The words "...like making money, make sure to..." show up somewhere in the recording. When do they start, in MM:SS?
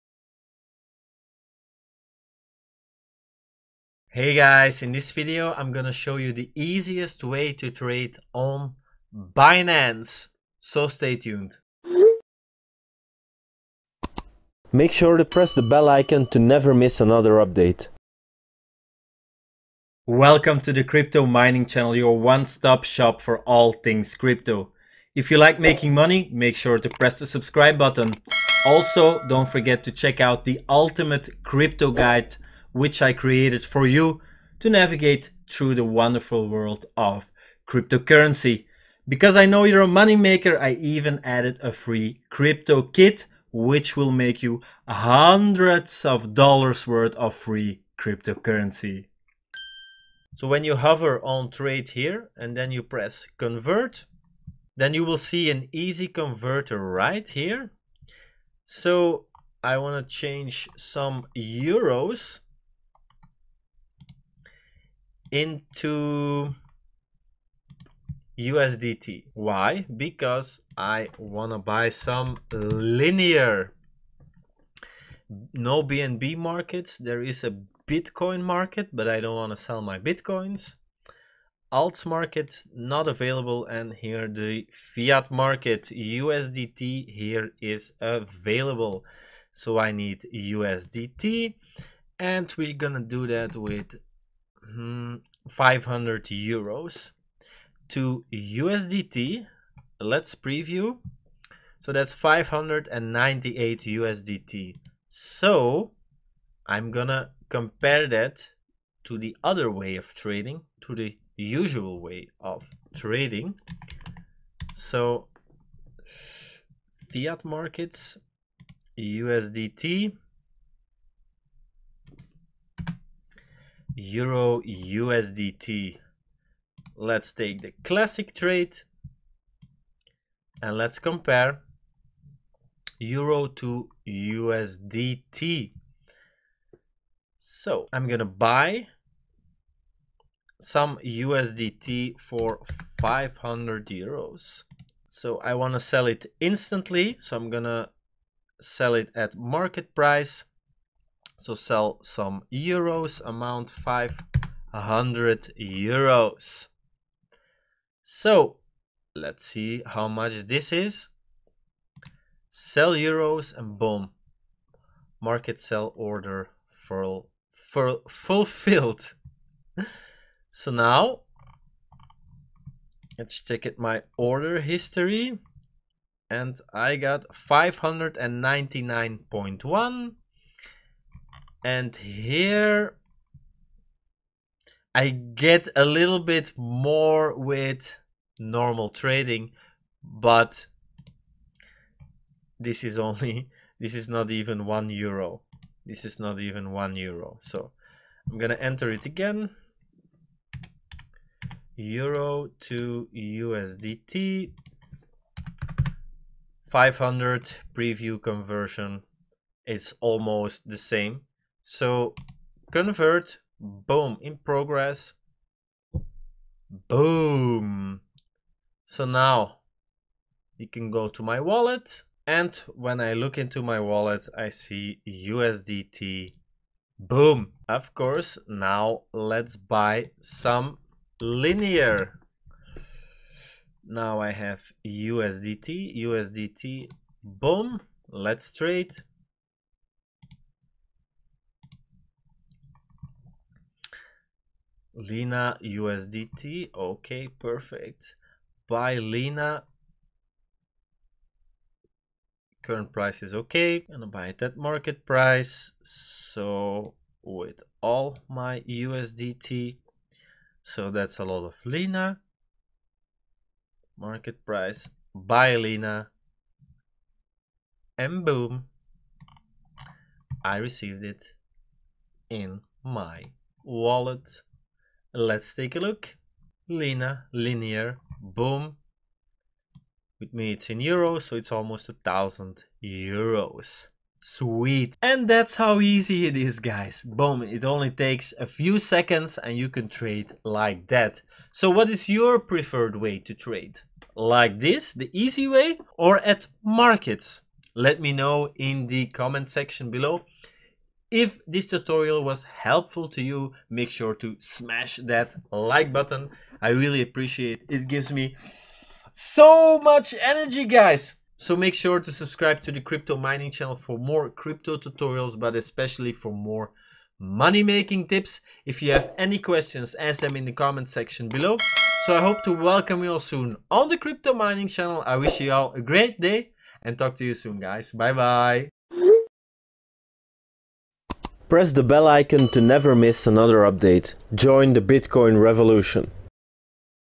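00:25.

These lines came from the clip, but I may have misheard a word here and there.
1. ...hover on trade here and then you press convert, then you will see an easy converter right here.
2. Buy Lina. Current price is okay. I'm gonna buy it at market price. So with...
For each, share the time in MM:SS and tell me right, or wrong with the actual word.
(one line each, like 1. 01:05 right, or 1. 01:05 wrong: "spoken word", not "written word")
1. 00:50 right
2. 04:08 right.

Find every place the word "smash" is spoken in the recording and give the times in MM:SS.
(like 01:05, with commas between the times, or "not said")
05:04.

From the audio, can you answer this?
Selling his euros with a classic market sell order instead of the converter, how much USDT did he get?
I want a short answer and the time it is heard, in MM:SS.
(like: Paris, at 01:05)
599.1, at 02:57.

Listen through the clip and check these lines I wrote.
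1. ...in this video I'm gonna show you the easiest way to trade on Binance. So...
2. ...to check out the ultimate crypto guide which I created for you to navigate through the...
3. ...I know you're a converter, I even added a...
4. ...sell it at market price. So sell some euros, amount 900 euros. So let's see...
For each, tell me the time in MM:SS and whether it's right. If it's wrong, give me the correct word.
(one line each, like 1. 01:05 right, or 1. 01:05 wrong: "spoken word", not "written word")
1. 00:04 right
2. 00:29 right
3. 00:39 wrong: "moneymaker", not "converter"
4. 02:28 wrong: "500", not "900".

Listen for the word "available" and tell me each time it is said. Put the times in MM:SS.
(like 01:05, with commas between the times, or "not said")
01:23, 01:28.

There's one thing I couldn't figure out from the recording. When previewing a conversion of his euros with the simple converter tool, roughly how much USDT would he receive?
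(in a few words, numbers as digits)
598 USDT.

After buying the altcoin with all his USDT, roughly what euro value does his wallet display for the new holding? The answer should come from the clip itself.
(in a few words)
almost 1000 euros.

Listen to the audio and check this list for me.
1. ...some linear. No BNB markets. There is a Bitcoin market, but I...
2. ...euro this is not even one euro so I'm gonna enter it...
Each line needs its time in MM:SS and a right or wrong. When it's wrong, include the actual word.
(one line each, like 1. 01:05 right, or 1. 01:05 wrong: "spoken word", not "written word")
1. 01:11 right
2. 03:14 right.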